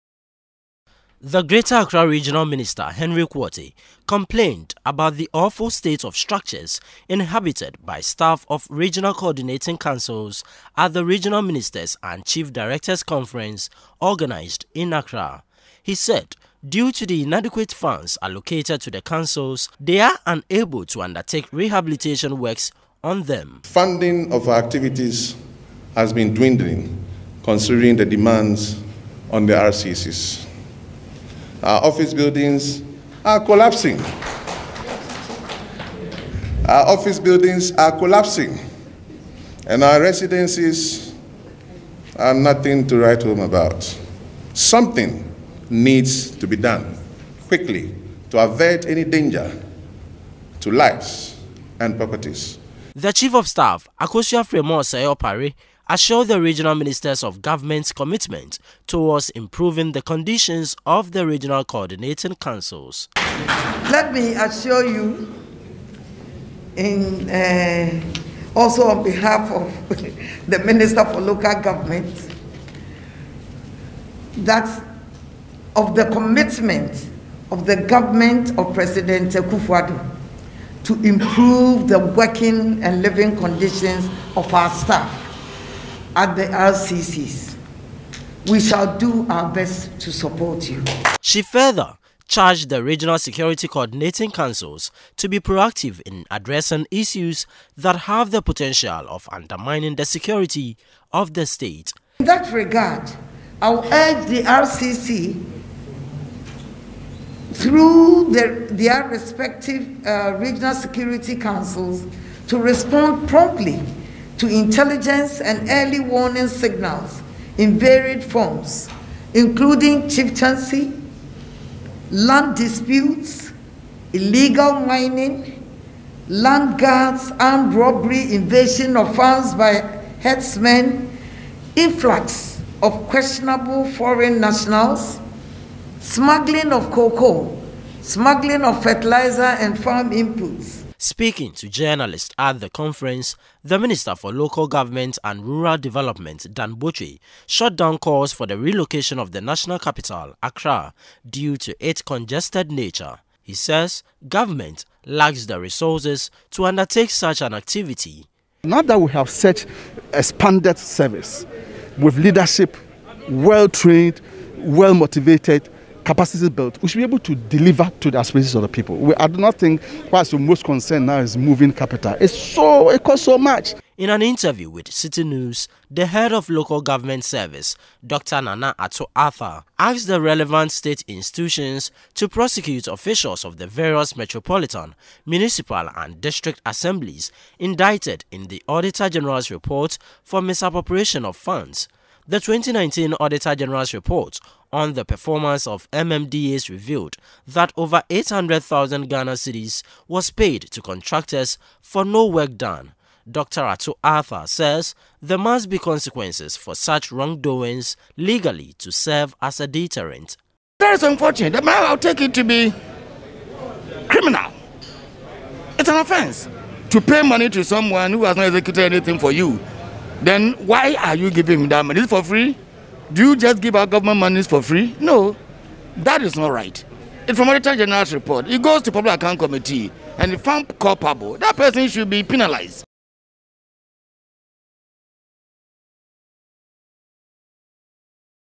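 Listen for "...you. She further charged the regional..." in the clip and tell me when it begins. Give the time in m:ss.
1:30.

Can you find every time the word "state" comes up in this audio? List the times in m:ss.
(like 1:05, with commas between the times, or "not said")
0:05, 1:41, 3:00.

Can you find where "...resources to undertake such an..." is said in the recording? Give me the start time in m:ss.
2:35.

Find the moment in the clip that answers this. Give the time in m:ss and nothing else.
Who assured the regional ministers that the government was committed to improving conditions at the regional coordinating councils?
0:54.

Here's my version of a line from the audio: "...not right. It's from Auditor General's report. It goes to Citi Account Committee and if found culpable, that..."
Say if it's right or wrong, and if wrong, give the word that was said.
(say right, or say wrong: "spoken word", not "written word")
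wrong: "Public", not "Citi".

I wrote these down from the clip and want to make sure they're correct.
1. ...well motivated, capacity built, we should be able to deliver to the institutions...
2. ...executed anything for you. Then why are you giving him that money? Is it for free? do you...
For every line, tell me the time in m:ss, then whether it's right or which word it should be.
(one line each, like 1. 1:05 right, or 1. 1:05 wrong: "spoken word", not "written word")
1. 2:44 wrong: "aspirations", not "institutions"
2. 3:38 right.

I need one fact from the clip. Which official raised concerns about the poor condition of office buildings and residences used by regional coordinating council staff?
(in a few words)
Henry Quartey.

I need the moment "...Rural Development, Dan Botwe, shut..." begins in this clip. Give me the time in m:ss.
2:25.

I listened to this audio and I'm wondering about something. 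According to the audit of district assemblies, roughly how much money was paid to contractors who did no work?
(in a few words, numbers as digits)
over 800,000 Ghana cedis.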